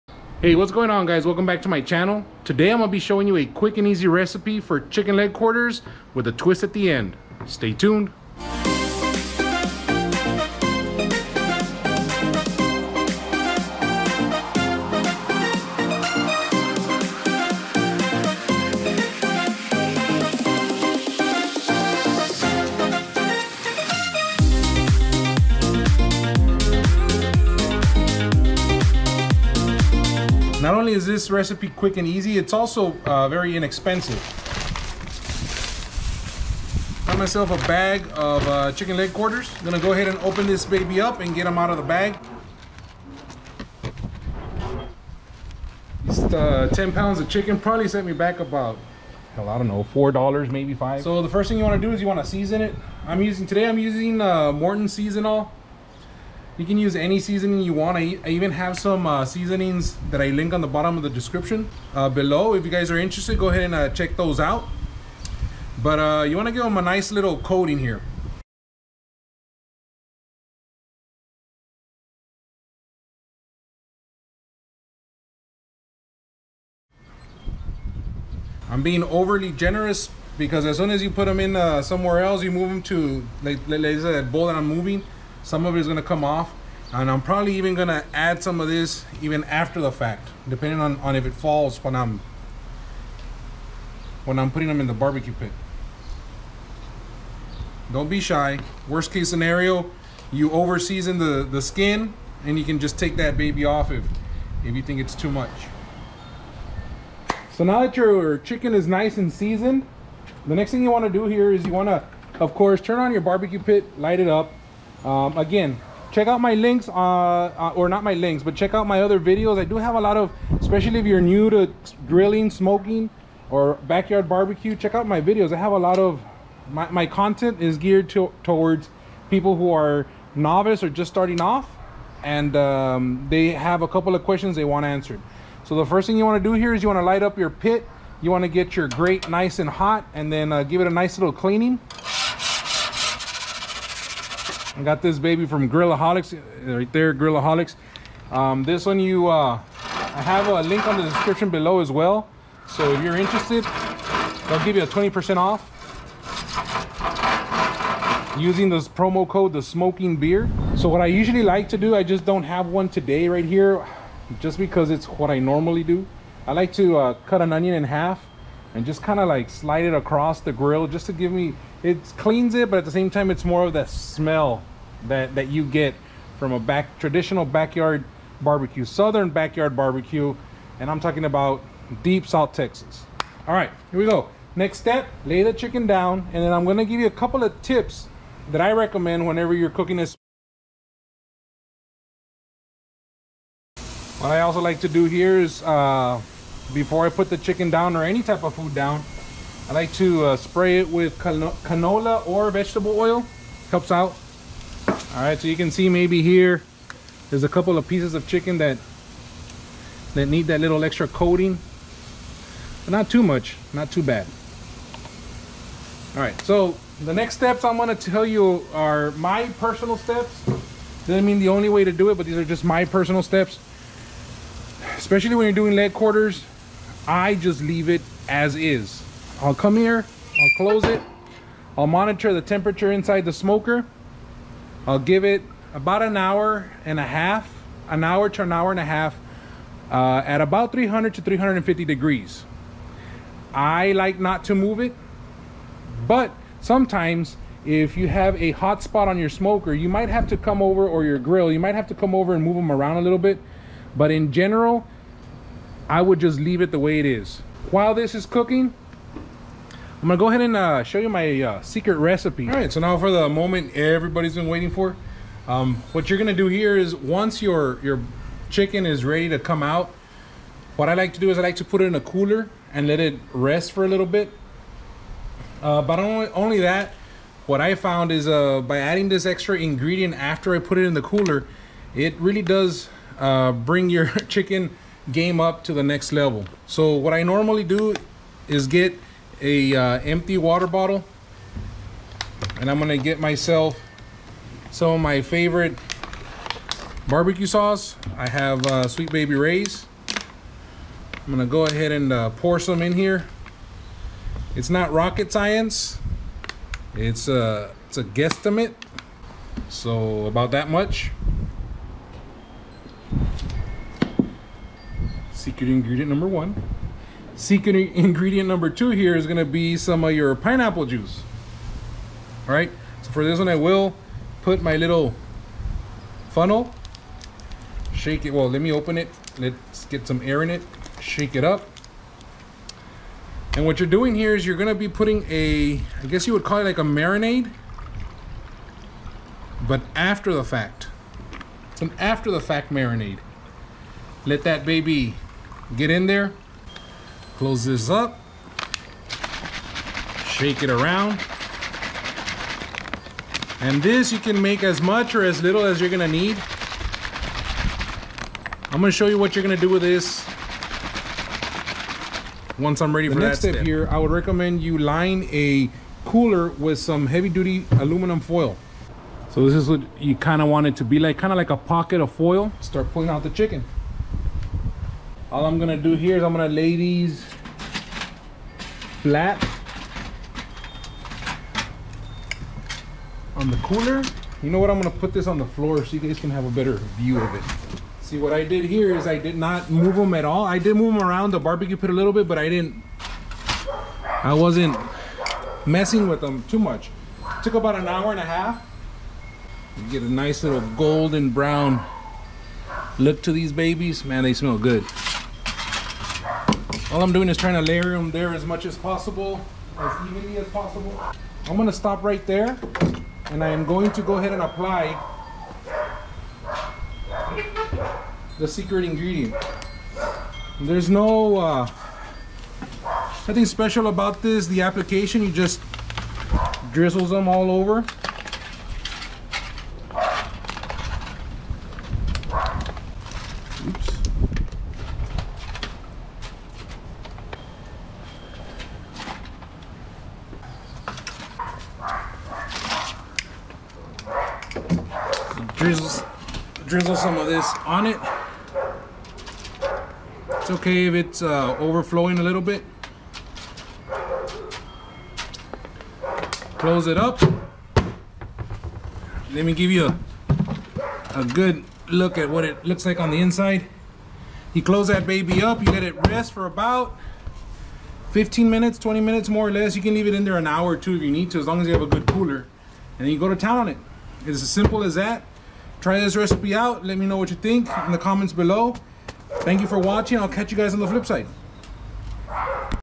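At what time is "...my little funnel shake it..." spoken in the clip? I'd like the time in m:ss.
5:24.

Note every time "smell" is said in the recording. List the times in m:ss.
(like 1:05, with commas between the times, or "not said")
2:53, 6:44.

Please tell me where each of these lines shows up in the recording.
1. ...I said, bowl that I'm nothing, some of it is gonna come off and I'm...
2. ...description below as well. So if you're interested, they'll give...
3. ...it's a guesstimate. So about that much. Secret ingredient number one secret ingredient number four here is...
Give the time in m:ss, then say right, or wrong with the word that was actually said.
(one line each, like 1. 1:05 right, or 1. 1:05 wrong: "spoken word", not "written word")
1. 1:23 wrong: "moving", not "nothing"
2. 2:31 right
3. 5:07 wrong: "two", not "four".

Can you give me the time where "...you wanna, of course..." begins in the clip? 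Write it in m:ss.
1:51.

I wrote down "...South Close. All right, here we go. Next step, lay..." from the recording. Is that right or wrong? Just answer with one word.
wrong.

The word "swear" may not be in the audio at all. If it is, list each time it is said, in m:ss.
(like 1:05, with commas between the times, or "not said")
not said.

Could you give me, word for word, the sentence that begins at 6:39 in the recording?
You get a nice little golden brown look to these babies.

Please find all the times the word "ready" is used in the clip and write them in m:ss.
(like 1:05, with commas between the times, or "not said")
4:29, 6:02.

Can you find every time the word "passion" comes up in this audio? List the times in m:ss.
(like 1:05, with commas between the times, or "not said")
not said.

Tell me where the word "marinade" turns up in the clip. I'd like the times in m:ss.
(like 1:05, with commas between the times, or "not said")
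5:36, 5:42.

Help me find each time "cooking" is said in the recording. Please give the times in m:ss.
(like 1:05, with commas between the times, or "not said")
3:09, 4:18.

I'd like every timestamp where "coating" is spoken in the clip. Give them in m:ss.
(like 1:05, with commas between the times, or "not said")
1:07, 3:31.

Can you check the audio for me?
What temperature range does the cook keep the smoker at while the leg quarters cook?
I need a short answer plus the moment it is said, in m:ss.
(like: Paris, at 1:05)
300 to 350 degrees, at 4:00.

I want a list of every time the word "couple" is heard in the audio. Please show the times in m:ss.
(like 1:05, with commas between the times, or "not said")
2:13, 3:07, 3:27.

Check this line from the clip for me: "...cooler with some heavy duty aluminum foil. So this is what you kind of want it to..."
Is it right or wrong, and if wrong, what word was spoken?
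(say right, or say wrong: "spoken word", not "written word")
right.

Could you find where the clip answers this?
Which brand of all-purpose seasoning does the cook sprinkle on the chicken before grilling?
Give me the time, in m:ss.
0:54.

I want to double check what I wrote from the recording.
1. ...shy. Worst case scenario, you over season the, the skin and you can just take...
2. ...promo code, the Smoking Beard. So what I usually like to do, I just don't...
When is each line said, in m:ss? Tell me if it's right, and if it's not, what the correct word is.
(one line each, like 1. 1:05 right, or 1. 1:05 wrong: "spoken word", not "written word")
1. 1:38 right
2. 2:38 right.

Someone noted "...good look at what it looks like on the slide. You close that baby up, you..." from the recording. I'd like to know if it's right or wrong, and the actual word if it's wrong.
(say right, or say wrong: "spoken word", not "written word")
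wrong: "inside", not "slide".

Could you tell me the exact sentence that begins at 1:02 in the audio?
If you guys are interested, go ahead and uh, check those out.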